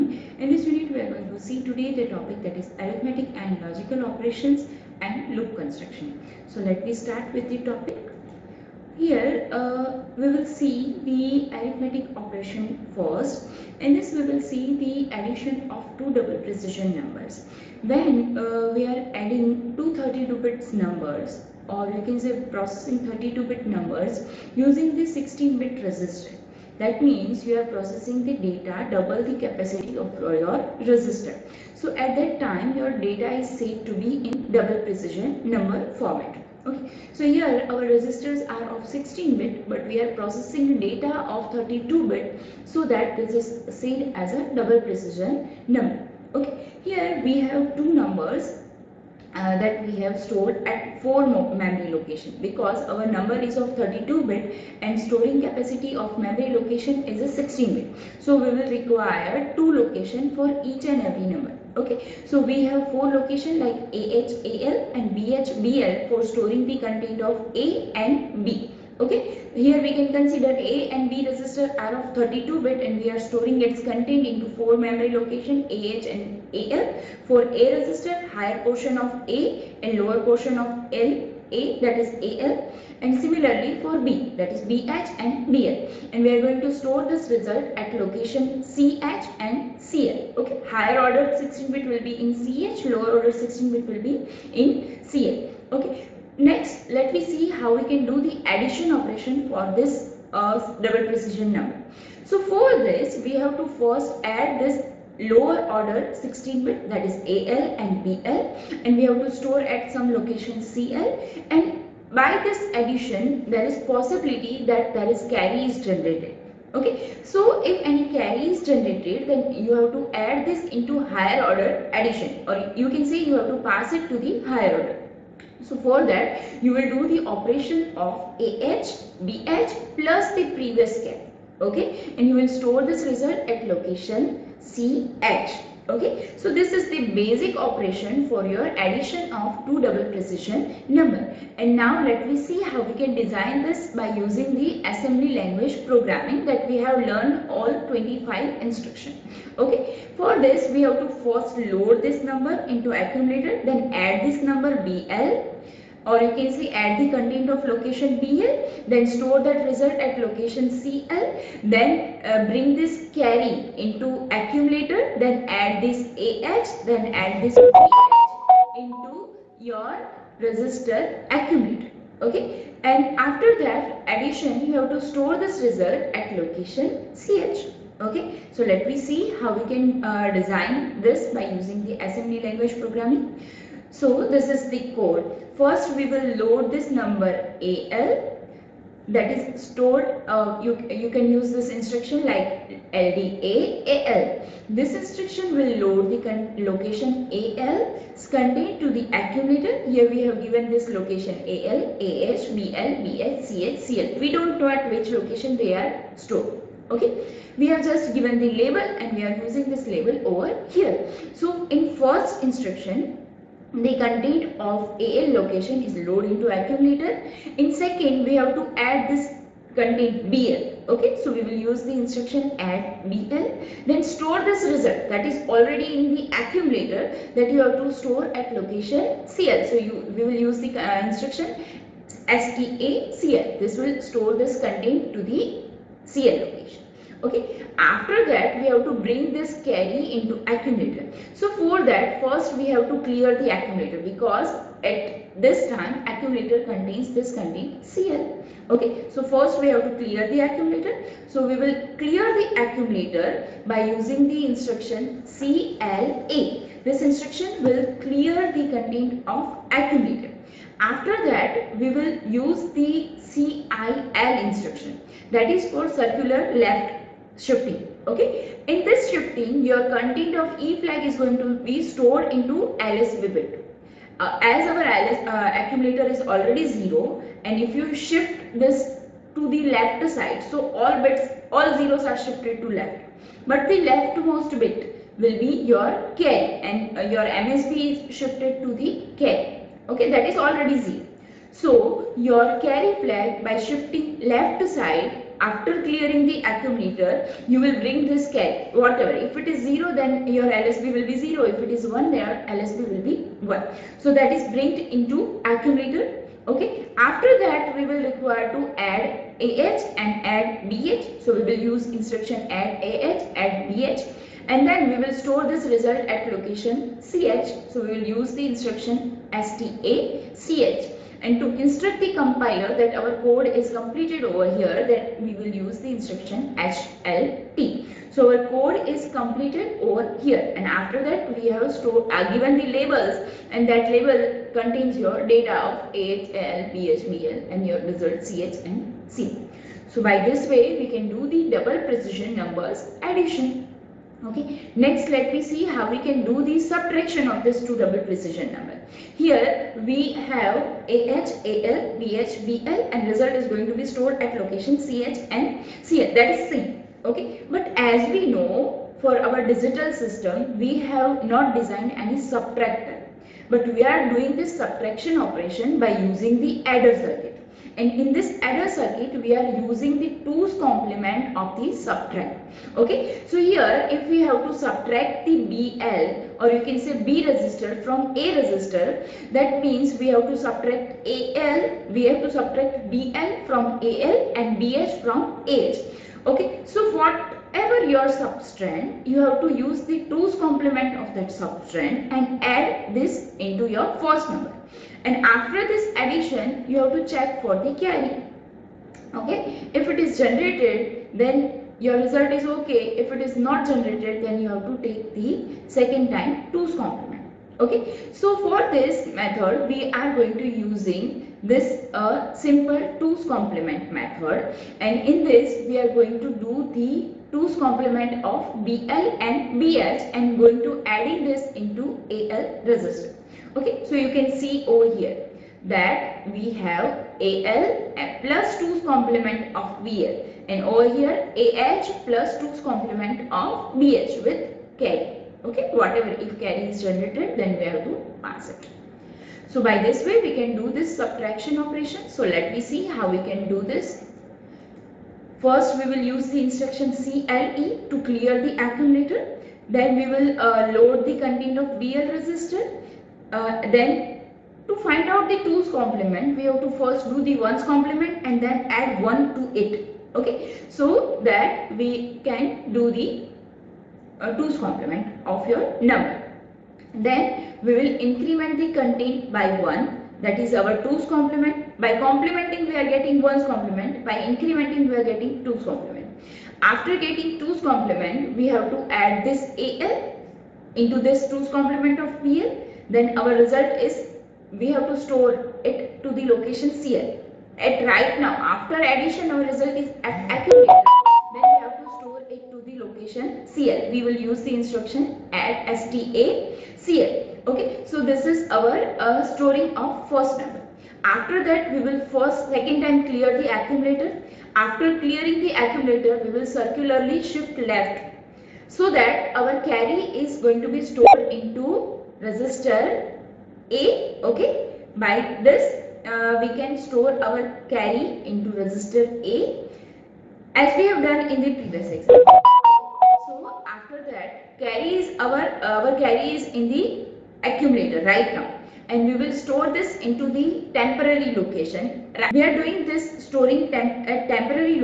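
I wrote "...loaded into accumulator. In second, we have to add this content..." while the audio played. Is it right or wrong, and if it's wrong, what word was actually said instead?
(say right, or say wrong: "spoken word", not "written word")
right.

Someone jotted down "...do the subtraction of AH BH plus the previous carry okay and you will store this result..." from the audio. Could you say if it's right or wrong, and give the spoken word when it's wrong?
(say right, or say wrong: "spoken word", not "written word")
wrong: "operation", not "subtraction".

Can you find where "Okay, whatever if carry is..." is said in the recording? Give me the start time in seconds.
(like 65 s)
435 s.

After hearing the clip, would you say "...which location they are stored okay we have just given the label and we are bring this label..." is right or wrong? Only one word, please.
wrong.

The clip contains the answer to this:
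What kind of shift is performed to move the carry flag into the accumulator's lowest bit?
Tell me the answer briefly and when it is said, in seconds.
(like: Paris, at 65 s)
Circular left shifting, at 265 s.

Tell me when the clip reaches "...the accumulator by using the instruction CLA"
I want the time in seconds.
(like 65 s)
252 s.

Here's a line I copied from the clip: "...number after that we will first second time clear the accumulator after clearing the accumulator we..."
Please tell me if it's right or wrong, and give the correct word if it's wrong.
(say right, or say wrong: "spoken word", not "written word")
right.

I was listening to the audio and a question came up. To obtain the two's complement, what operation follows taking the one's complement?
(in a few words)
Increment by 1.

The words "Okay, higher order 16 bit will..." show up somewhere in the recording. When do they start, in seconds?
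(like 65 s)
90 s.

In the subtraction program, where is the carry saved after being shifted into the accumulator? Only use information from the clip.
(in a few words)
Temporary location.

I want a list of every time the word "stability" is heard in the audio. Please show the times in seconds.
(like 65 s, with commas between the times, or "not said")
not said.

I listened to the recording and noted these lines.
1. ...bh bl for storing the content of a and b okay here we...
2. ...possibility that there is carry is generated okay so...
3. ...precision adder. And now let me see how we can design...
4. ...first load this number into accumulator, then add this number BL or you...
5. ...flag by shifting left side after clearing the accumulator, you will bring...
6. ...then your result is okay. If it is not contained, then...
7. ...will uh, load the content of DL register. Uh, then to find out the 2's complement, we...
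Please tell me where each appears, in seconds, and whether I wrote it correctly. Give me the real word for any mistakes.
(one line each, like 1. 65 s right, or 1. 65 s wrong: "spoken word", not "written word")
1. 65 s right
2. 113 s right
3. 140 s wrong: "number", not "adder"
4. 151 s right
5. 293 s right
6. 401 s wrong: "generated", not "contained"
7. 450 s right.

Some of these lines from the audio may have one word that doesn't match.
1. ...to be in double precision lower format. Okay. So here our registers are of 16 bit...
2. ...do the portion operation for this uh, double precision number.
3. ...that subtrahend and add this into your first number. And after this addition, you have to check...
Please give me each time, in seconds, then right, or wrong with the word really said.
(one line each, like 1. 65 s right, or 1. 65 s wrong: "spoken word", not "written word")
1. 33 s wrong: "number", not "lower"
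2. 98 s wrong: "addition", not "portion"
3. 391 s right.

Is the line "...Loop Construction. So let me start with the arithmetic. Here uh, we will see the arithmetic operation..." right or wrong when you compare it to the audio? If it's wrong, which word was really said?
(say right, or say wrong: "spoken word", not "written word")
wrong: "topic", not "arithmetic".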